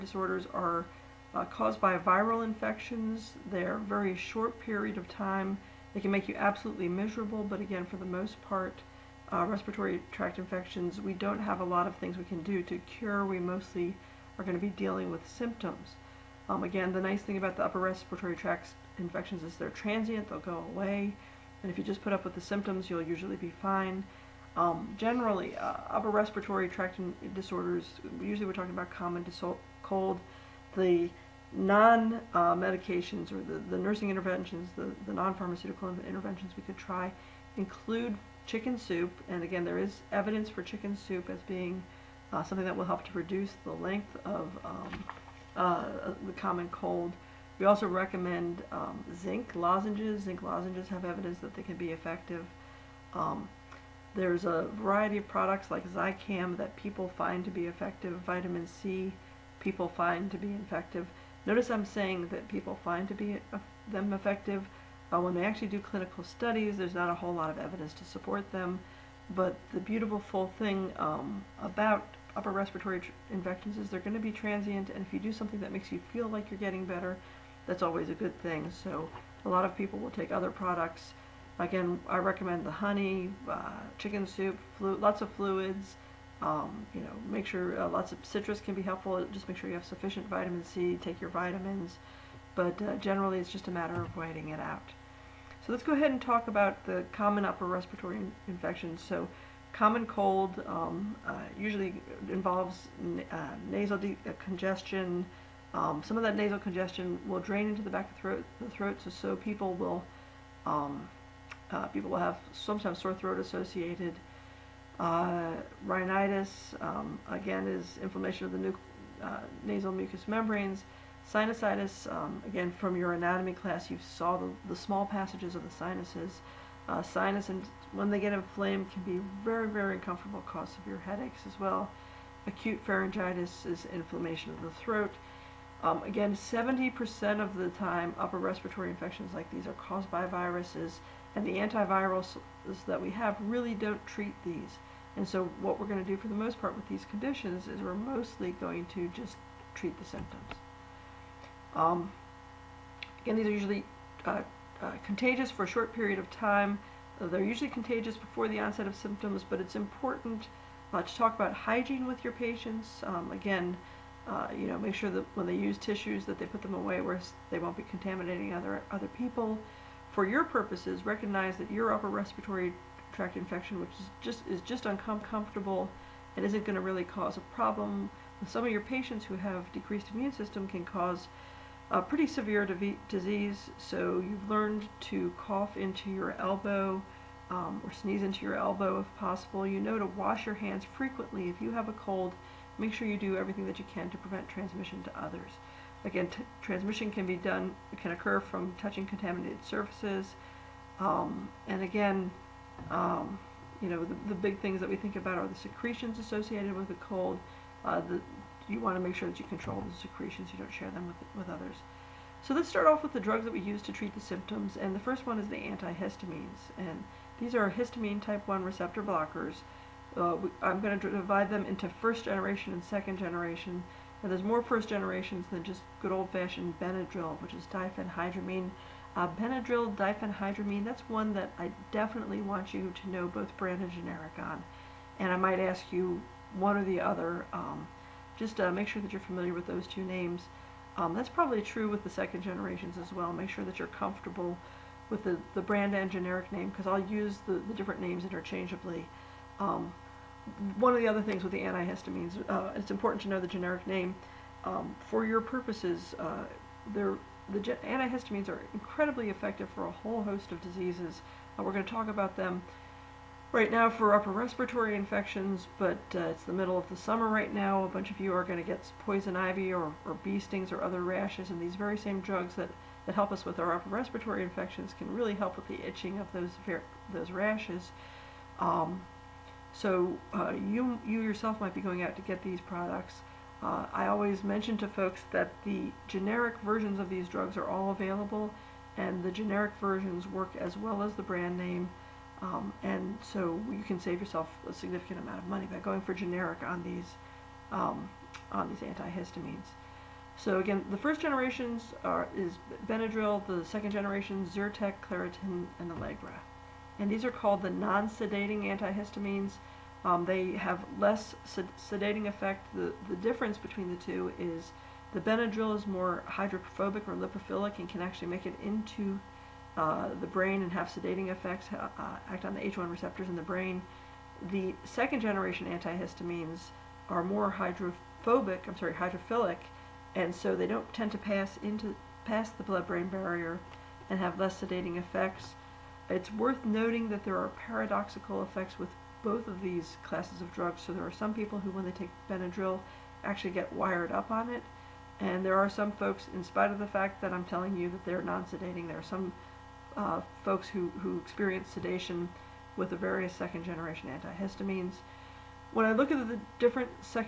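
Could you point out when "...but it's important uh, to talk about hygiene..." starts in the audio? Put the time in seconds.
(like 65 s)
159 s.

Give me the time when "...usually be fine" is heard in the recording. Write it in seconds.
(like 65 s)
23 s.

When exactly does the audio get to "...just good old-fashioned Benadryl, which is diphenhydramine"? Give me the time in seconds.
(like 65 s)
225 s.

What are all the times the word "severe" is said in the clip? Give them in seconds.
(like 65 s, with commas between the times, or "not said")
130 s, 182 s.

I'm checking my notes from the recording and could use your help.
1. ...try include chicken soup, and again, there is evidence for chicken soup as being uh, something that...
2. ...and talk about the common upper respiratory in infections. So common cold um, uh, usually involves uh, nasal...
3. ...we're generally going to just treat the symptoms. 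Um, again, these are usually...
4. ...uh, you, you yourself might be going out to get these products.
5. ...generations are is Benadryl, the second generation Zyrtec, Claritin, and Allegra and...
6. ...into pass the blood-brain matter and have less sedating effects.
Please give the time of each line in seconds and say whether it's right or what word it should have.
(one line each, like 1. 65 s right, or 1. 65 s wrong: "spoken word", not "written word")
1. 36 s right
2. 96 s right
3. 147 s wrong: "mostly", not "generally"
4. 280 s right
5. 301 s right
6. 331 s wrong: "barrier", not "matter".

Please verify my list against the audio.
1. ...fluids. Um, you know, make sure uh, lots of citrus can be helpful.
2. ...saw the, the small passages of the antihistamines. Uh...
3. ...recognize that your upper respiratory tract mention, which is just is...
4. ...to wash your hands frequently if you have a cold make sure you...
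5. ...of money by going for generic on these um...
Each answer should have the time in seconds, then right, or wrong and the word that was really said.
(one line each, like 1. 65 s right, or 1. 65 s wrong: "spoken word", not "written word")
1. 85 s right
2. 123 s wrong: "sinuses", not "antihistamines"
3. 171 s wrong: "infection", not "mention"
4. 189 s right
5. 295 s right.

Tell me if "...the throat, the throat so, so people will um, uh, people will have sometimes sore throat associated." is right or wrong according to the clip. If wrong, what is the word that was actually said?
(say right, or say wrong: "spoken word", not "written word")
right.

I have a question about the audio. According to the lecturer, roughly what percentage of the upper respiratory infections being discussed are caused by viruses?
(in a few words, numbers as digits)
70%.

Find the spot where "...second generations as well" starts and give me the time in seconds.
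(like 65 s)
242 s.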